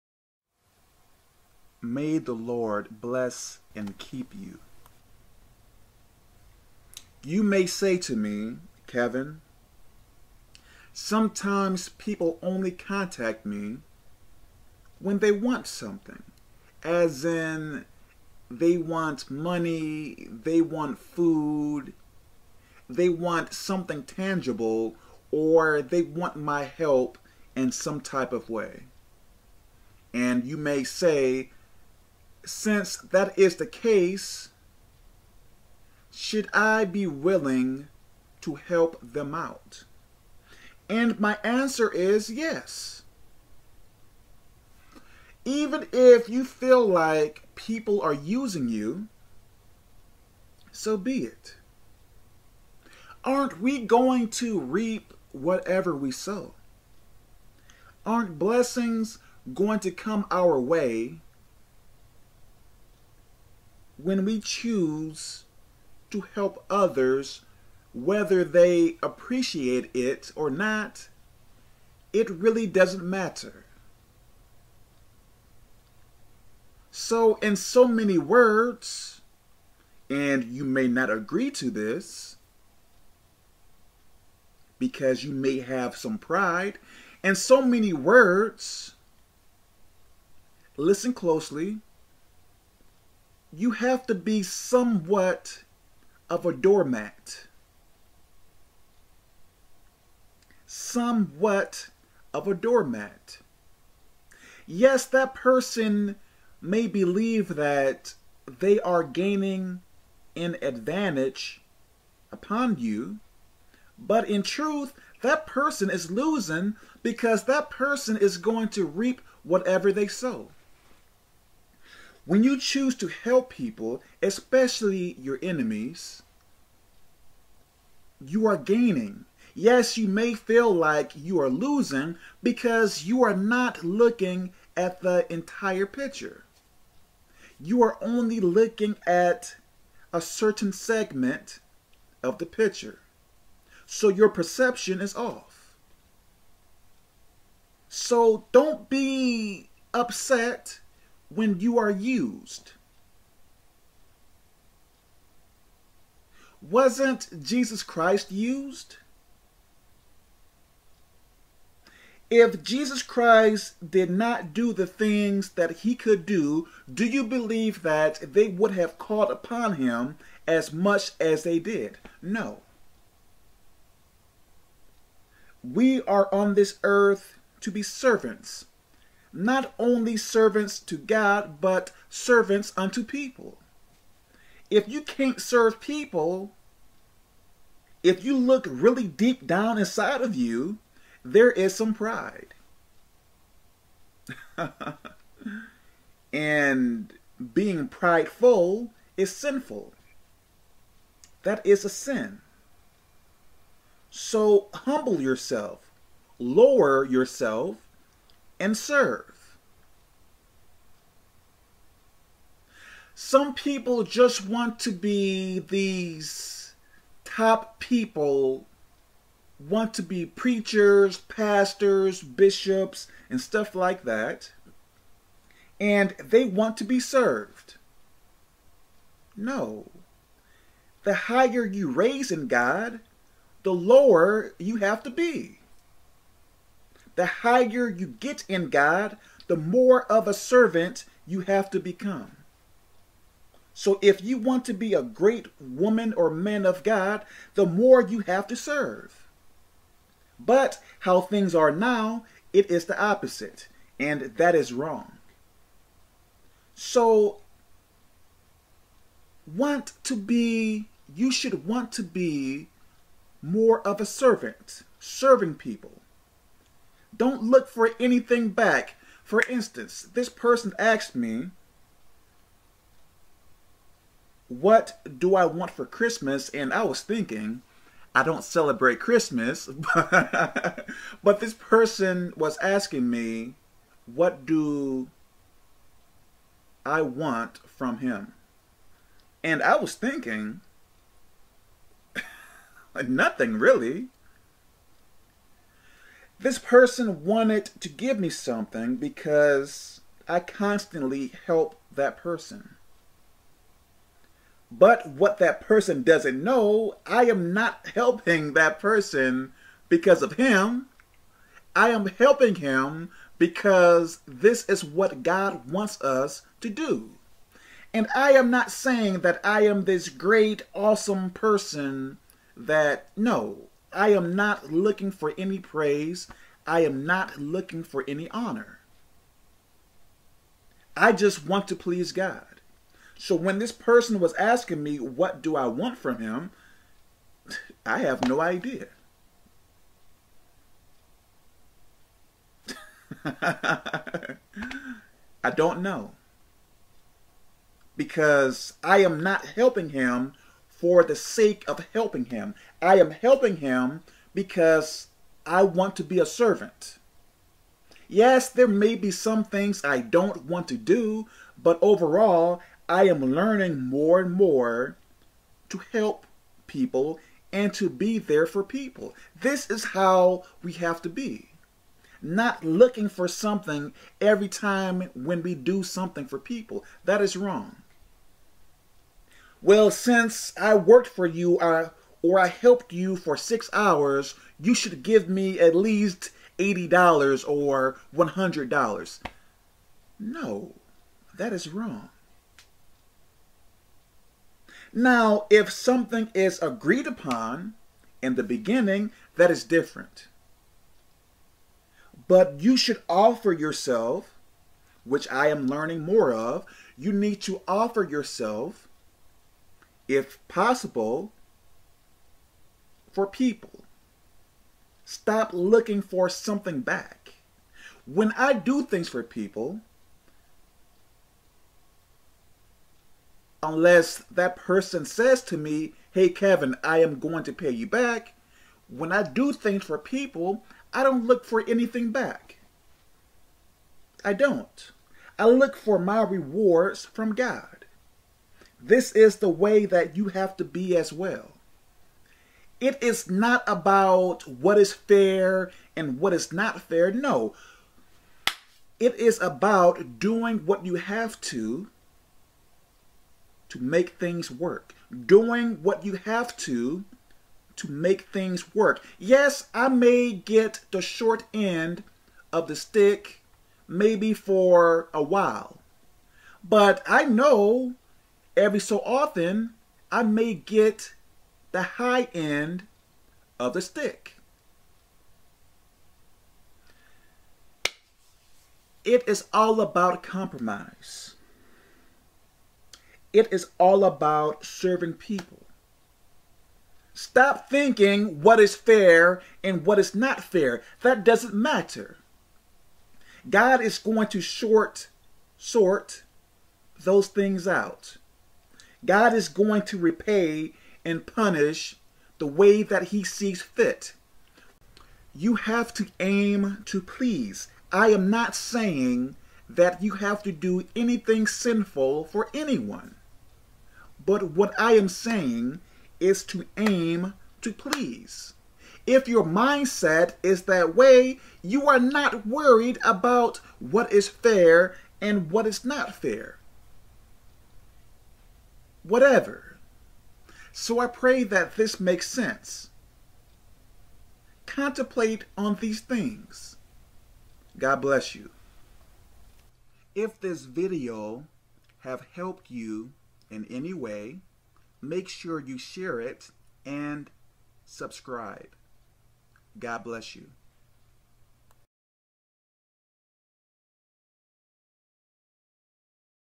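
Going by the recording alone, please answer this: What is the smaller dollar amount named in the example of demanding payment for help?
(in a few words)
$80.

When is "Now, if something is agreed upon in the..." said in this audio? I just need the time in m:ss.
6:34.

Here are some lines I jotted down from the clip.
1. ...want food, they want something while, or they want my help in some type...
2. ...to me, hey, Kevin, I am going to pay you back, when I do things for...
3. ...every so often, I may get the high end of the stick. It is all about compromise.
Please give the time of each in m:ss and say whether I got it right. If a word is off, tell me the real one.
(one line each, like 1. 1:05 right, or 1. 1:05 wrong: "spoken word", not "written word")
1. 0:20 wrong: "tangible", not "while"
2. 7:05 right
3. 7:48 right.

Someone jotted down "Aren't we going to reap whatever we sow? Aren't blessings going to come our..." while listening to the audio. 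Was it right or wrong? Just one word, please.
right.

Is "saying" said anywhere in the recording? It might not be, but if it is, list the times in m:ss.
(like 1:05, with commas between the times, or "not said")
5:18, 8:28, 8:35.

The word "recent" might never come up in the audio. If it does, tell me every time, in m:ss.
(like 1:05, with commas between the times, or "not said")
not said.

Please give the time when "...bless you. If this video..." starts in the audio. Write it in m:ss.
8:58.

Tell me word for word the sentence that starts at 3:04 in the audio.
If you can't serve people, if you look really deep down inside of you, there is some pride.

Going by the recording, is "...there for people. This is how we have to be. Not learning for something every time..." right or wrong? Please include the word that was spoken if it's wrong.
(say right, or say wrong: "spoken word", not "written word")
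wrong: "looking", not "learning".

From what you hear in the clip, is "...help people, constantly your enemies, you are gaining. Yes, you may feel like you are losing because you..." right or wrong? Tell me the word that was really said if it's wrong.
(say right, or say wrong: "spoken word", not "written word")
wrong: "especially", not "constantly".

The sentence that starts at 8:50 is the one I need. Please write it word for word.
So I pray that this makes sense.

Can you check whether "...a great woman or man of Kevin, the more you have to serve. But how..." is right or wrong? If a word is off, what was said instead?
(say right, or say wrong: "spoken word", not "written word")
wrong: "God", not "Kevin".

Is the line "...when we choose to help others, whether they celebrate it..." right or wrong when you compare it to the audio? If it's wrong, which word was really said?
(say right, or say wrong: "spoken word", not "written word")
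wrong: "appreciate", not "celebrate".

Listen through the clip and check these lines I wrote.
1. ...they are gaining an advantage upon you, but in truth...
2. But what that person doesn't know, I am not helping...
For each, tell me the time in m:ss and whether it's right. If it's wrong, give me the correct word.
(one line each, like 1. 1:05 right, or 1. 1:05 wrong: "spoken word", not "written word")
1. 1:48 right
2. 5:04 right.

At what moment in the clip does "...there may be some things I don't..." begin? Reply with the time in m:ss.
5:58.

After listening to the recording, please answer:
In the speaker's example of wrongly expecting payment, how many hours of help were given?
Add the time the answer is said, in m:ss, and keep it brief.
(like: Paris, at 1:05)
6, at 6:23.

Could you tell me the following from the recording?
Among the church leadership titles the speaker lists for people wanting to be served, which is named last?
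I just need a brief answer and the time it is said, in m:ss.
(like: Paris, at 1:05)
bishops, at 3:42.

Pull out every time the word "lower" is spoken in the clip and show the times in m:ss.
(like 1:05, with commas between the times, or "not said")
3:26, 3:53.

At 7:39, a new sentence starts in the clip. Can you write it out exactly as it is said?
Yes, I may get the short end of the stick maybe for a while.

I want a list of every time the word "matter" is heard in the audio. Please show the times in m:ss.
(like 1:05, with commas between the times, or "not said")
1:13, 8:11.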